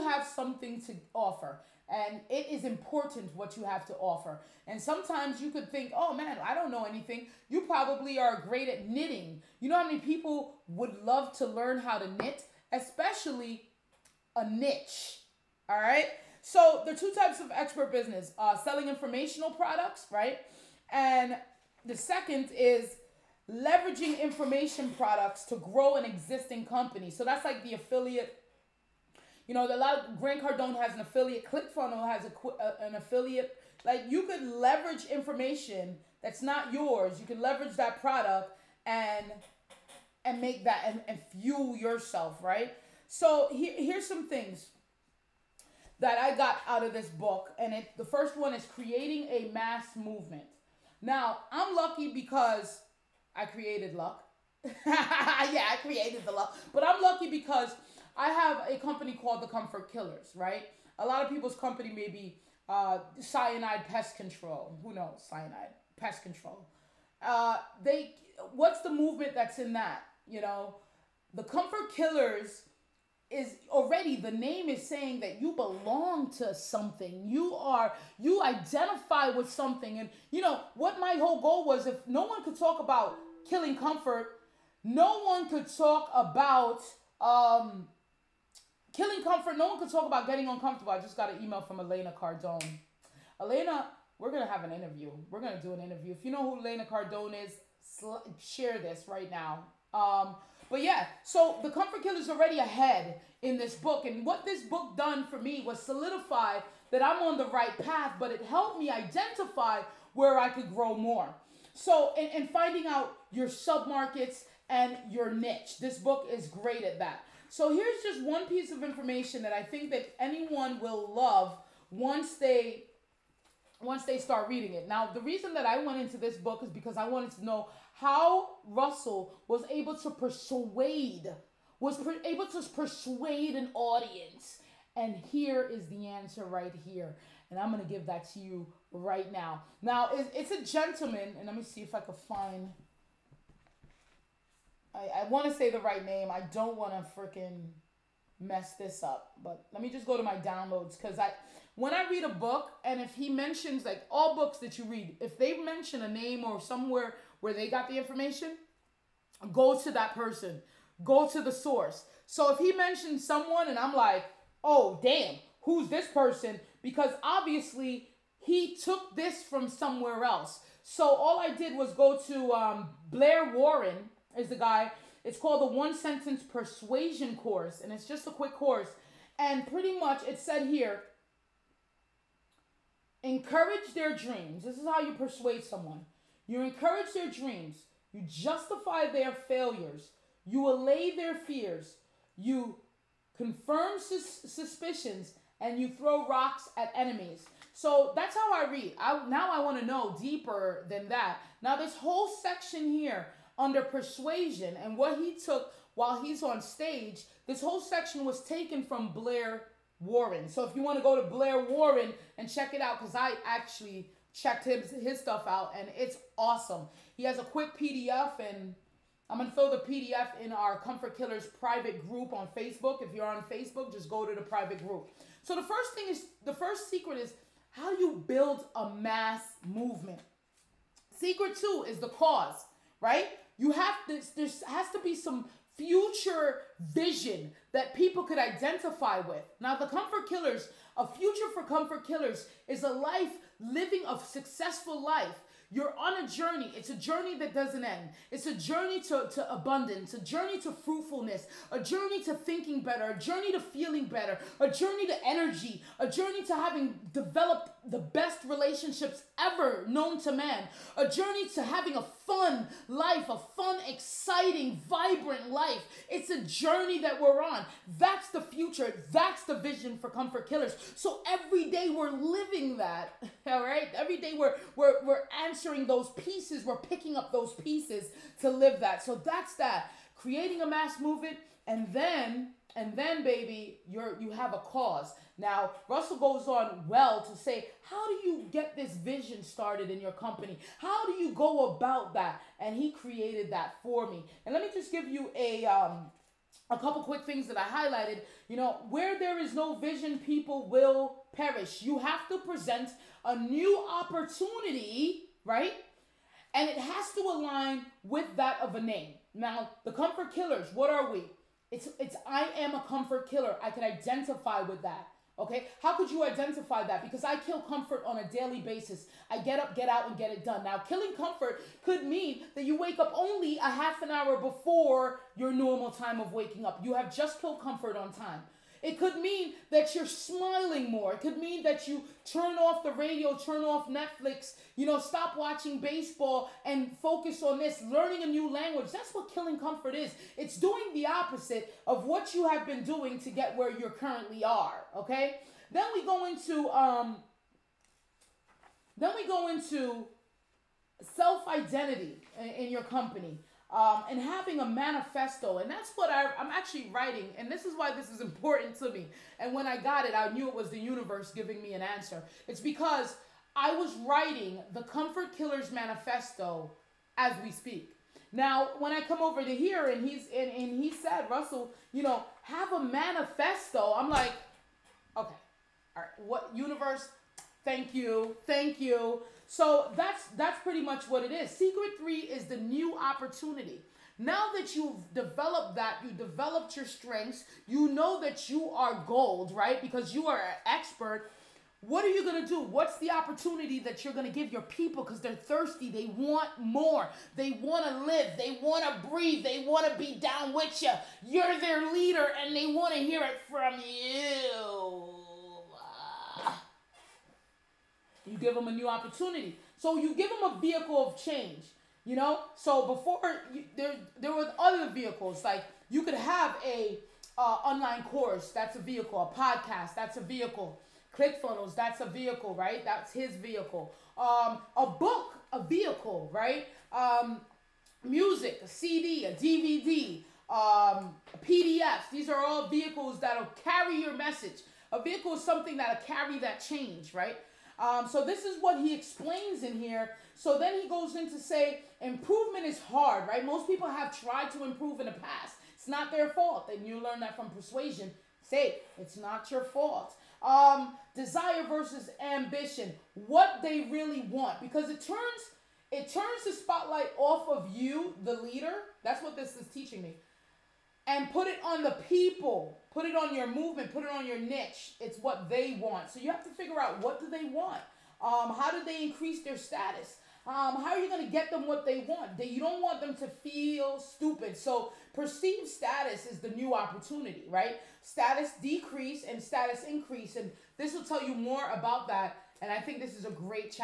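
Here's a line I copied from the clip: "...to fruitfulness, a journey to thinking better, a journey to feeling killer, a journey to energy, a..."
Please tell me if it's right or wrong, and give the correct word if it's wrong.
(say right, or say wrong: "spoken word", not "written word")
wrong: "better", not "killer".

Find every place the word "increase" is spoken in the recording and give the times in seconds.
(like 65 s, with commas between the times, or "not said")
469 s, 479 s.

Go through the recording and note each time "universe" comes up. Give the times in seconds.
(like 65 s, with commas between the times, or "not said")
360 s, 376 s.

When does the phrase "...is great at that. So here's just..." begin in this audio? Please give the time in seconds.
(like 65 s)
116 s.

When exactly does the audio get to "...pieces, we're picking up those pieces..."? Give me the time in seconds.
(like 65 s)
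276 s.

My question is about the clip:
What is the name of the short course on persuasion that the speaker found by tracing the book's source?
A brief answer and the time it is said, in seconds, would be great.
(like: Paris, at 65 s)
One Sentence Persuasion Course, at 175 s.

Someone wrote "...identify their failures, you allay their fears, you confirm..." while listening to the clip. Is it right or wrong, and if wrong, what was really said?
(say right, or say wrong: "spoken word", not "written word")
wrong: "justify", not "identify".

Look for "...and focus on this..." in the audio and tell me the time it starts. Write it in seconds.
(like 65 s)
336 s.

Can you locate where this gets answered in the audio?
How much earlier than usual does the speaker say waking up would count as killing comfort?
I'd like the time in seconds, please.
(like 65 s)
323 s.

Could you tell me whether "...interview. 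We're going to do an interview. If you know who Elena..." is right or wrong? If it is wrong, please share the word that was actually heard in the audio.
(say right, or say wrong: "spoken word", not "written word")
right.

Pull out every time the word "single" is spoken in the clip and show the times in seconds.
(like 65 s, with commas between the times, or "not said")
not said.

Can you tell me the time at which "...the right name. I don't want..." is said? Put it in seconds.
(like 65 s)
145 s.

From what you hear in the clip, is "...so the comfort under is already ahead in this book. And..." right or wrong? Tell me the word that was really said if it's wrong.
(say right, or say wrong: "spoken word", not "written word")
wrong: "killer", not "under".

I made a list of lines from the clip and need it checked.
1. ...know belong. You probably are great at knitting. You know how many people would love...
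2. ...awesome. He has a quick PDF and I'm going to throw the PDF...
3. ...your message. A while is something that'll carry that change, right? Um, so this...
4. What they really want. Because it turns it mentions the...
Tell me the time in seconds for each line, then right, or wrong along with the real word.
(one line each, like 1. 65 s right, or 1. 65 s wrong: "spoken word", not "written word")
1. 6 s wrong: "anything", not "belong"
2. 216 s right
3. 434 s wrong: "vehicle", not "while"
4. 453 s wrong: "turns", not "mentions".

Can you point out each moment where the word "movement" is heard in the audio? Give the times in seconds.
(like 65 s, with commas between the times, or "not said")
49 s, 68 s, 229 s, 281 s, 463 s.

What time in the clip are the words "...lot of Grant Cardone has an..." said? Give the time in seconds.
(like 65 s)
29 s.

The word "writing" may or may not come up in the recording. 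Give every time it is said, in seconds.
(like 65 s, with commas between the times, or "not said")
356 s, 364 s.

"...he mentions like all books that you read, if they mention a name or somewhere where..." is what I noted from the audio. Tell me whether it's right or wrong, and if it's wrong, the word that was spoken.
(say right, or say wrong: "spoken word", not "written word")
right.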